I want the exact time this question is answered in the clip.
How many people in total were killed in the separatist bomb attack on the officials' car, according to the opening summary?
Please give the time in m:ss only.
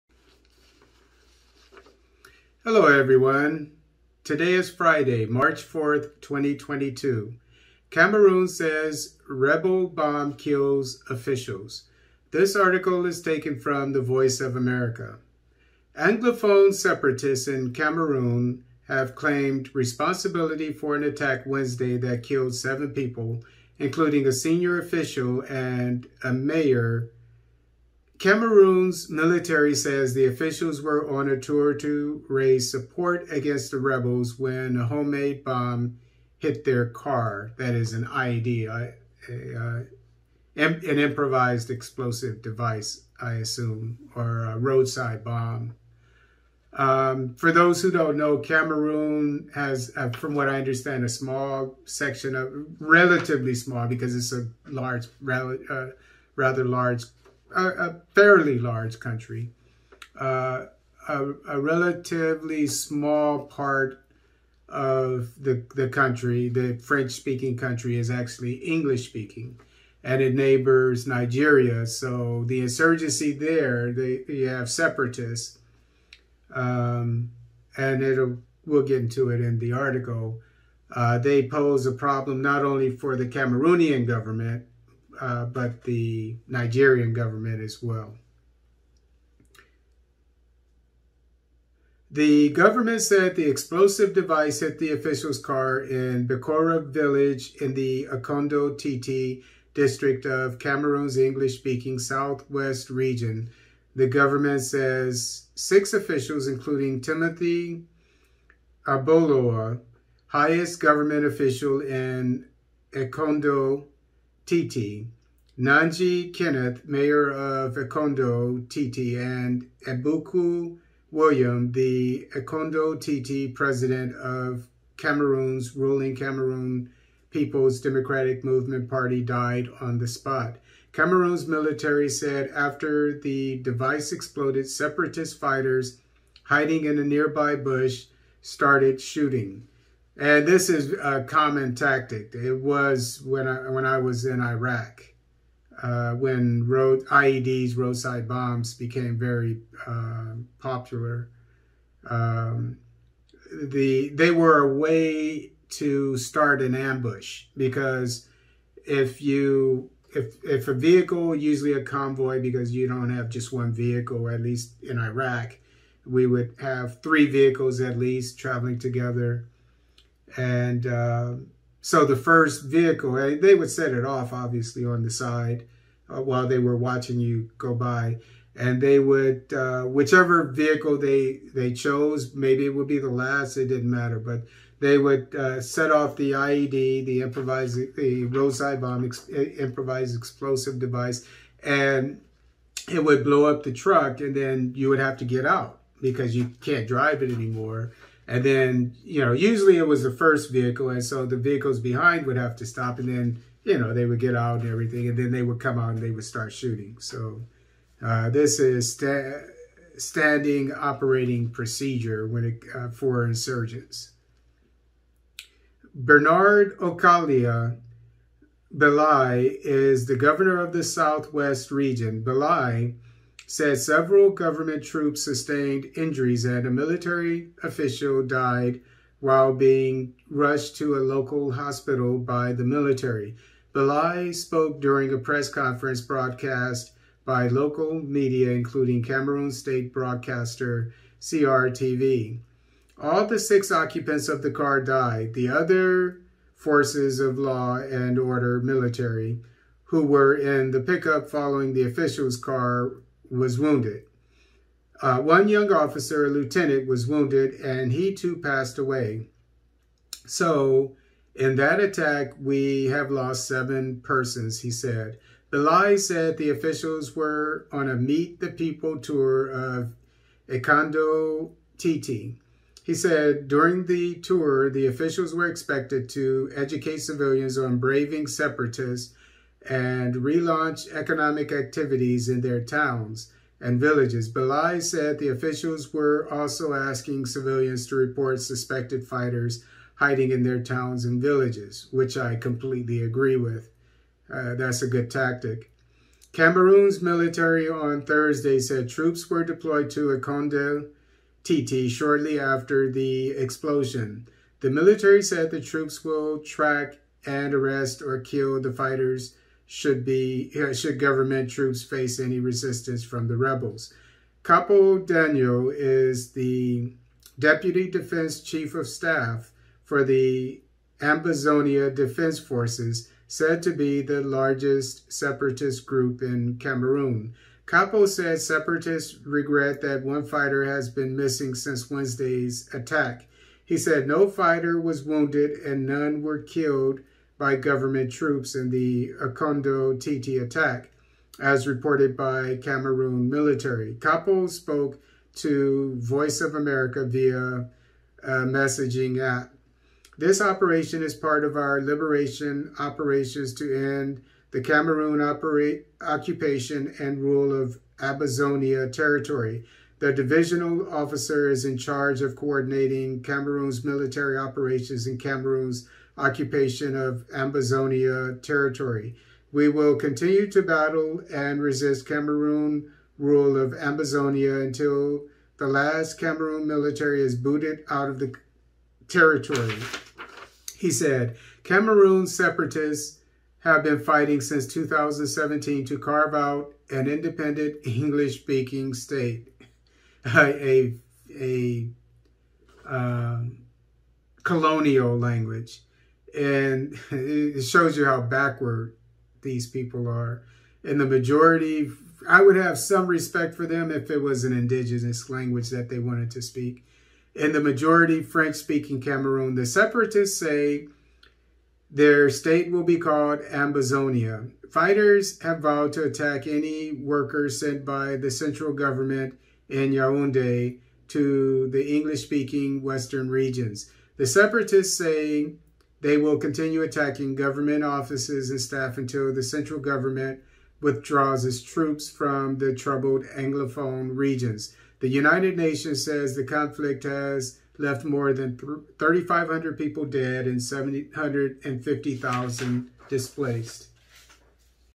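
0:22.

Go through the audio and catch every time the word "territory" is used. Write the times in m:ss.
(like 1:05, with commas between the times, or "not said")
5:58, 6:08, 6:19.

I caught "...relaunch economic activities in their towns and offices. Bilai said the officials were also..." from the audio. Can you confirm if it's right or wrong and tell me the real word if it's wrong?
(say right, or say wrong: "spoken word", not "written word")
wrong: "villages", not "offices".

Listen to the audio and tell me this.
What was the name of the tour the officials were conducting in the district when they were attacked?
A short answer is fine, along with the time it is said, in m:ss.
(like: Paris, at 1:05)
Meet the People, at 4:27.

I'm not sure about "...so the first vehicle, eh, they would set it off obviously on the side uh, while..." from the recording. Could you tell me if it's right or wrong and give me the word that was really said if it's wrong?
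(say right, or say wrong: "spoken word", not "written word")
right.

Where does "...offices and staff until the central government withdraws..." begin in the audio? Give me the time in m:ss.
7:07.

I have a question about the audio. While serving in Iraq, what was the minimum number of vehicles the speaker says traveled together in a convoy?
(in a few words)
3.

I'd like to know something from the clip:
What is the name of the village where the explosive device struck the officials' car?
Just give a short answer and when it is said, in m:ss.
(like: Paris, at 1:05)
Bikora, at 1:36.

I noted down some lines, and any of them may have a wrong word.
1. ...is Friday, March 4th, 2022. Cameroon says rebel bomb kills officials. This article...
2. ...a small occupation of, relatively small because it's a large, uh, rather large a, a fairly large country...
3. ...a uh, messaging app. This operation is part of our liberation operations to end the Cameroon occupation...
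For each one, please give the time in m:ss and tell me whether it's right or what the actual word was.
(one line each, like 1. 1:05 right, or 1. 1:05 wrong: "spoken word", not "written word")
1. 0:04 right
2. 0:51 wrong: "section", not "occupation"
3. 5:48 right.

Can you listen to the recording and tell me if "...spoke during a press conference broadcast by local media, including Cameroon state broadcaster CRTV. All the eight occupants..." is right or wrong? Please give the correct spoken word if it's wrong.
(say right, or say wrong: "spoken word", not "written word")
wrong: "six", not "eight".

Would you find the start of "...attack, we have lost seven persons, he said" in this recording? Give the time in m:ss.
4:21.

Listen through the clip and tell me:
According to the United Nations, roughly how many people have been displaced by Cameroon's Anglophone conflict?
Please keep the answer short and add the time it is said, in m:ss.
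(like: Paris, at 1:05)
750,000, at 7:20.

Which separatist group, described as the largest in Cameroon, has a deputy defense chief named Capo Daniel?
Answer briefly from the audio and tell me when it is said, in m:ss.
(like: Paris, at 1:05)
Ambazonia Defense Forces, at 5:20.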